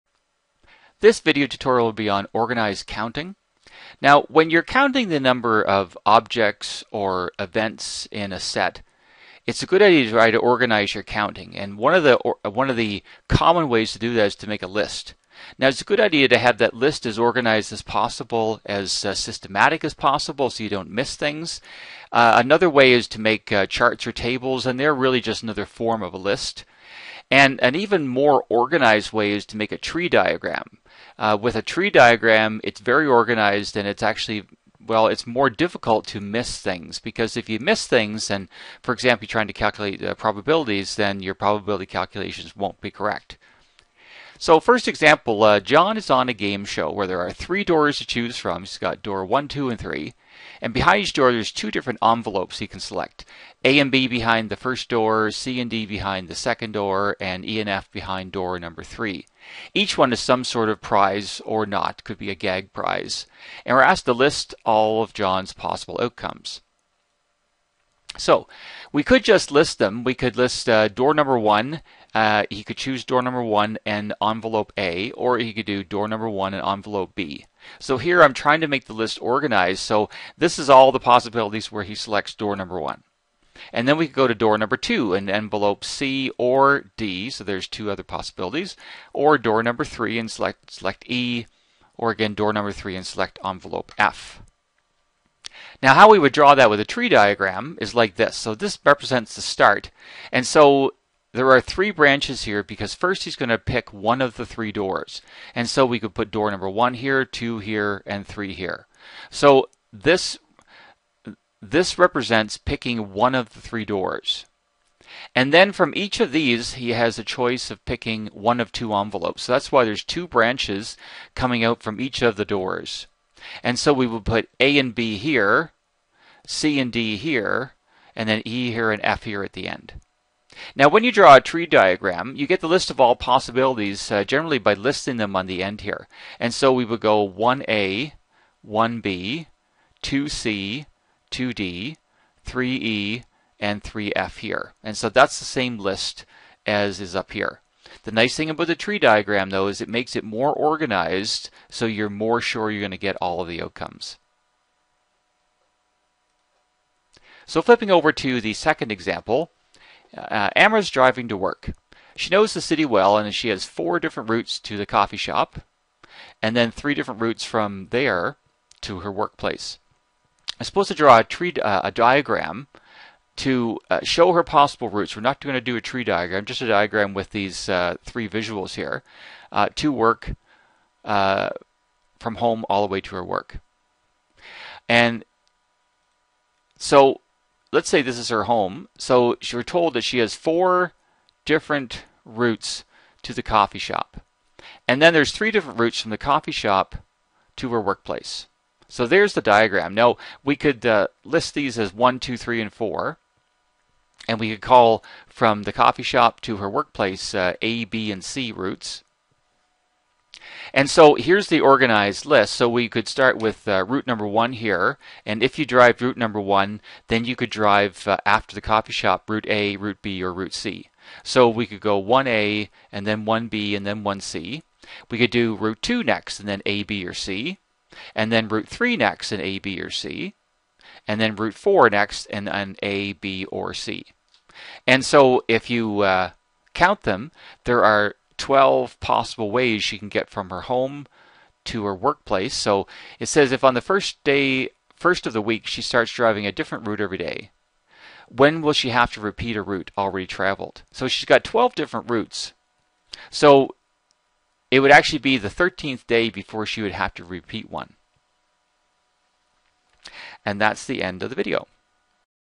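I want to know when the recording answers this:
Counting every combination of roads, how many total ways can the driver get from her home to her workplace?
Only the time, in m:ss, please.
3:58.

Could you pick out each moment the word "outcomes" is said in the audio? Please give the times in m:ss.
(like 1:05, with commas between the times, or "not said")
1:06, 2:33.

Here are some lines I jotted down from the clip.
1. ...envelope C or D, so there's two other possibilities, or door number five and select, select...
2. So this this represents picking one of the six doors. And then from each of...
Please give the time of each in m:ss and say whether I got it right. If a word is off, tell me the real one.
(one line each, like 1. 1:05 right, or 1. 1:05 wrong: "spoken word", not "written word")
1. 1:25 wrong: "three", not "five"
2. 1:49 wrong: "three", not "six".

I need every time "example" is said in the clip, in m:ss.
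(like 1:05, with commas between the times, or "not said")
0:38, 0:44, 2:38.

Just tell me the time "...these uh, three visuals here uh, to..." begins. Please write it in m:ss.
2:57.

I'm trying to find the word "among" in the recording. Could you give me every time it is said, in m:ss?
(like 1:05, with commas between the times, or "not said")
not said.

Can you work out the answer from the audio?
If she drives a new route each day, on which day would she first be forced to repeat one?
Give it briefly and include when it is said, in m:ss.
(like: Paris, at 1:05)
13th day, at 4:15.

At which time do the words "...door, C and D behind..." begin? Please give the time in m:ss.
0:54.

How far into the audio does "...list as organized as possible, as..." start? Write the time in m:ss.
0:16.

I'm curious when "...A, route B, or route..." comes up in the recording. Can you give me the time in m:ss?
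3:39.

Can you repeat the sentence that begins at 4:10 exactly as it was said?
So she's got 12 different routes.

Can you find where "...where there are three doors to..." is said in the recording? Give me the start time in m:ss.
0:46.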